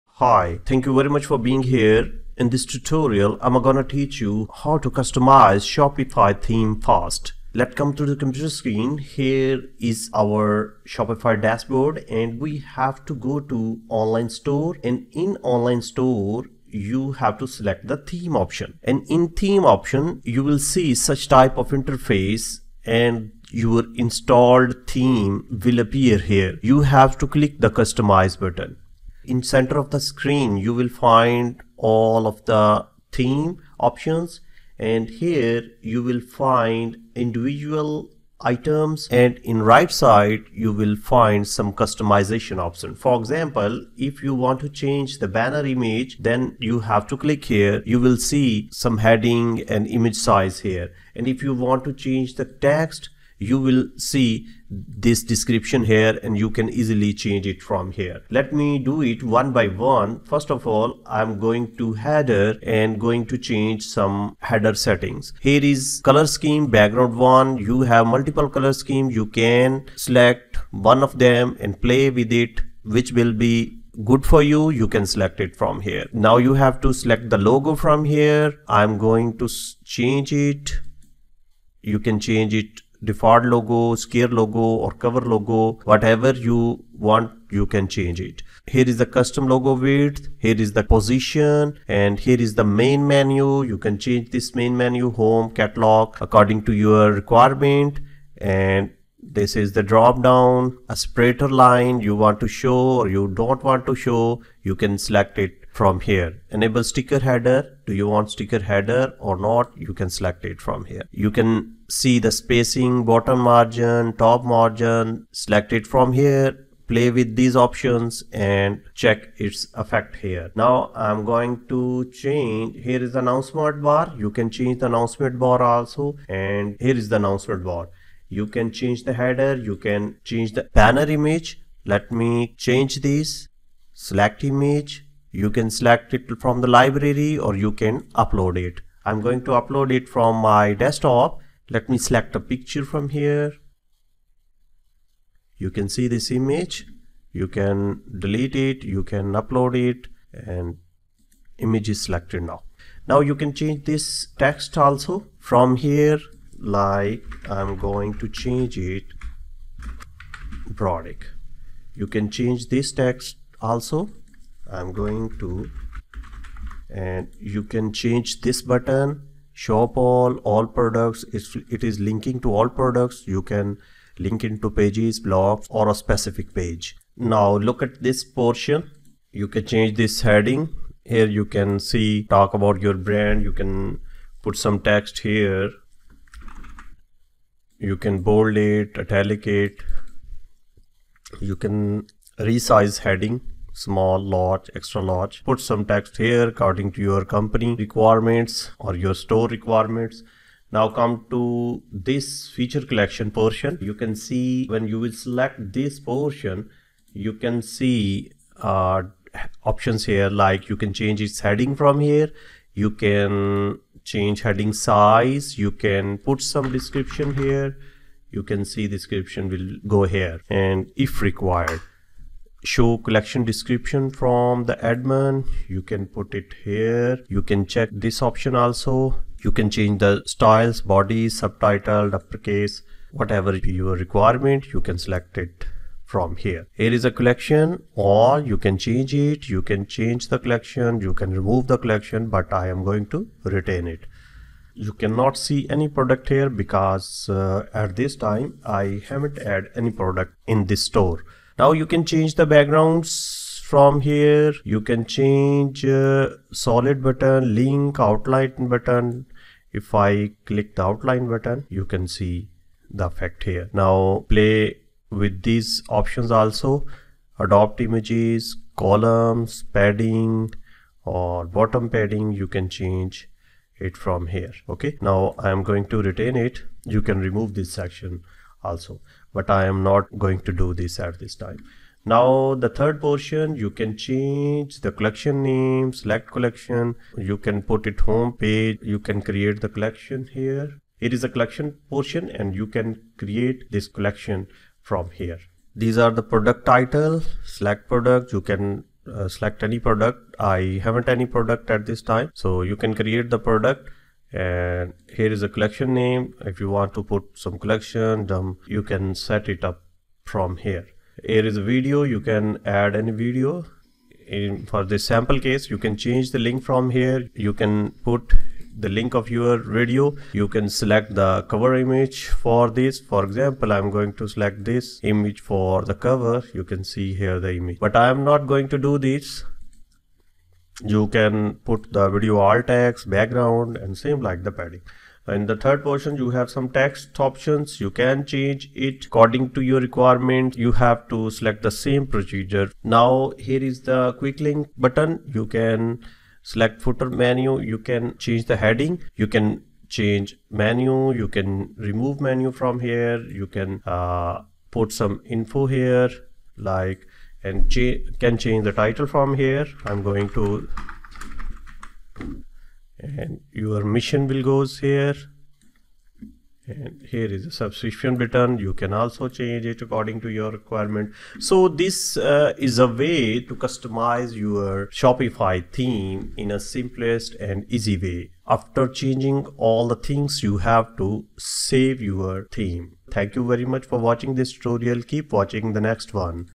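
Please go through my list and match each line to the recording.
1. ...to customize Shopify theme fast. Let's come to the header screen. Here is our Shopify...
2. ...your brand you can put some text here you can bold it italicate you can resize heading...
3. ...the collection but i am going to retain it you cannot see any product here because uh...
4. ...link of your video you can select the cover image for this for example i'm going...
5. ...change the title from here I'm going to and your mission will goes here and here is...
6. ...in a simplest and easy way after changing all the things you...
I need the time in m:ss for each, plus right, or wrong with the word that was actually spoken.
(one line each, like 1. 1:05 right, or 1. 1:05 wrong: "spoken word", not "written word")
1. 0:04 wrong: "computer", not "header"
2. 3:02 right
3. 4:01 right
4. 5:18 right
5. 5:58 right
6. 6:16 right.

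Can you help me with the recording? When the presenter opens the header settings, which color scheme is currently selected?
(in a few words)
Background 1.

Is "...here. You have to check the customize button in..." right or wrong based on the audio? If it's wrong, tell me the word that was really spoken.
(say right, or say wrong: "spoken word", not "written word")
wrong: "click", not "check".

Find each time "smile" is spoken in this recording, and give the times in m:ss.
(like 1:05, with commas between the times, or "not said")
not said.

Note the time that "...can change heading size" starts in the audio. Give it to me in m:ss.
3:32.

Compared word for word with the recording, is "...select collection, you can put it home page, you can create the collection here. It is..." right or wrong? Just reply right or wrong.
right.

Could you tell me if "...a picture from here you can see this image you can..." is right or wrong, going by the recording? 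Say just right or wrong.
right.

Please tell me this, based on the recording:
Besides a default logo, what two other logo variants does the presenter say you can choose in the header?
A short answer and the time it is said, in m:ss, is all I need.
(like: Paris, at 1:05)
Scare logo or cover logo, at 1:23.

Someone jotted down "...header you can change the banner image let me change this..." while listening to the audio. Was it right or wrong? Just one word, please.
right.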